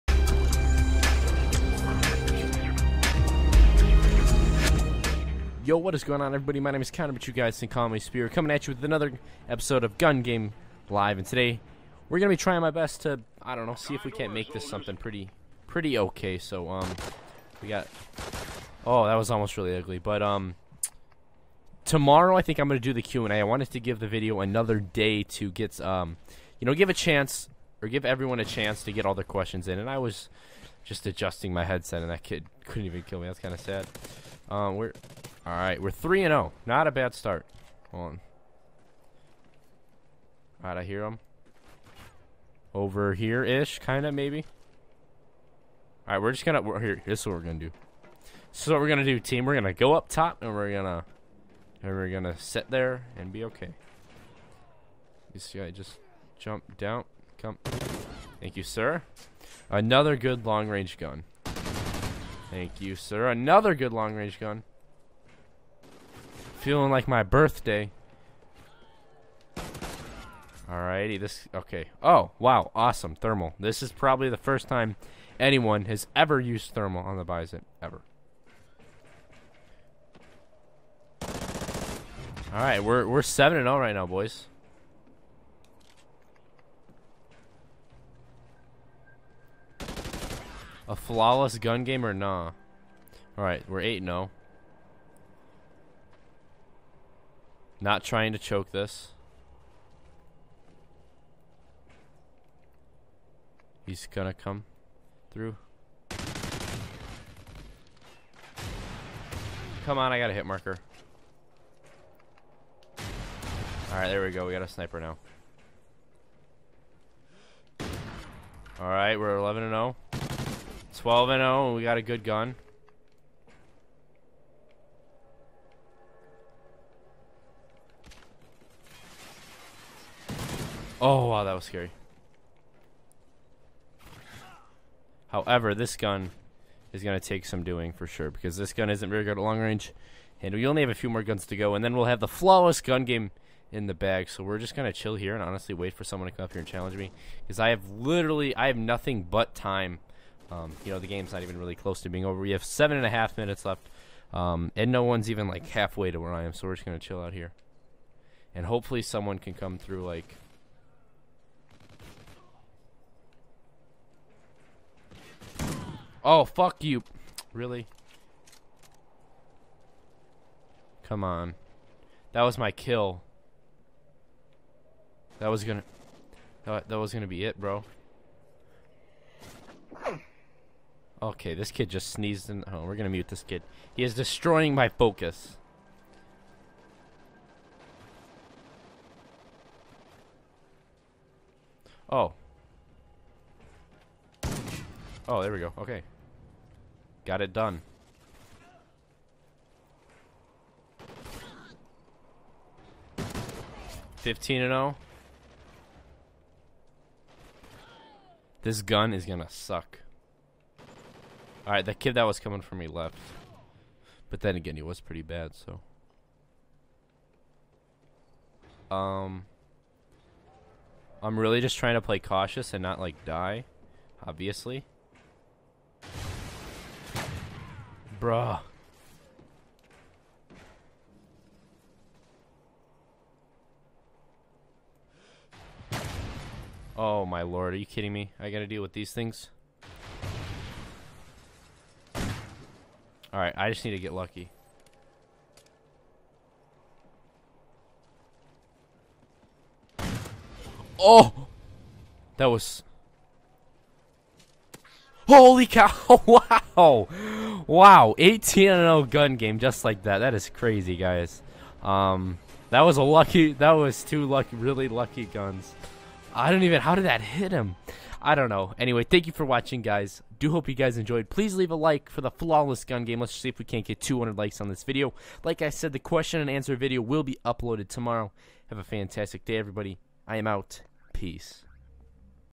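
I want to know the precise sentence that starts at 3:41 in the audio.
I'm really just trying to play cautious and not, like, die.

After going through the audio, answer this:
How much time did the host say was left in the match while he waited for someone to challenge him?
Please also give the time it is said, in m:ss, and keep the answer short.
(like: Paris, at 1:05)
7.5 minutes, at 2:32.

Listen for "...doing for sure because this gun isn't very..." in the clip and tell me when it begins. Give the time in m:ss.
2:17.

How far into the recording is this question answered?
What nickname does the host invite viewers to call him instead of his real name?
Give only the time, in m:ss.
0:07.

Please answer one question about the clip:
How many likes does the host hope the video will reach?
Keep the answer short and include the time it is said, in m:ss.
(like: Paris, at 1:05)
200, at 4:33.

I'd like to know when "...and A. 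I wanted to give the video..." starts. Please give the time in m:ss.
0:23.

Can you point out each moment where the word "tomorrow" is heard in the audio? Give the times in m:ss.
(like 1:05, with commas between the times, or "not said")
0:21, 4:37.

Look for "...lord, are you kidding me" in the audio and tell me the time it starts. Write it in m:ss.
3:57.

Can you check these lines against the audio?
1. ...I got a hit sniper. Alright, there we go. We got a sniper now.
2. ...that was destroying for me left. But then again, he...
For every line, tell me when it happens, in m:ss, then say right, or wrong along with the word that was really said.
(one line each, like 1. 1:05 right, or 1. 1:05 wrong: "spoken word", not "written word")
1. 1:50 wrong: "marker", not "sniper"
2. 3:32 wrong: "coming", not "destroying".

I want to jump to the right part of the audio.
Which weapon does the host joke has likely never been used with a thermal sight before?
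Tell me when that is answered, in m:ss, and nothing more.
1:17.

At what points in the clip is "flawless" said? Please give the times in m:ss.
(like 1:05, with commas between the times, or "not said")
1:30, 2:22, 4:32.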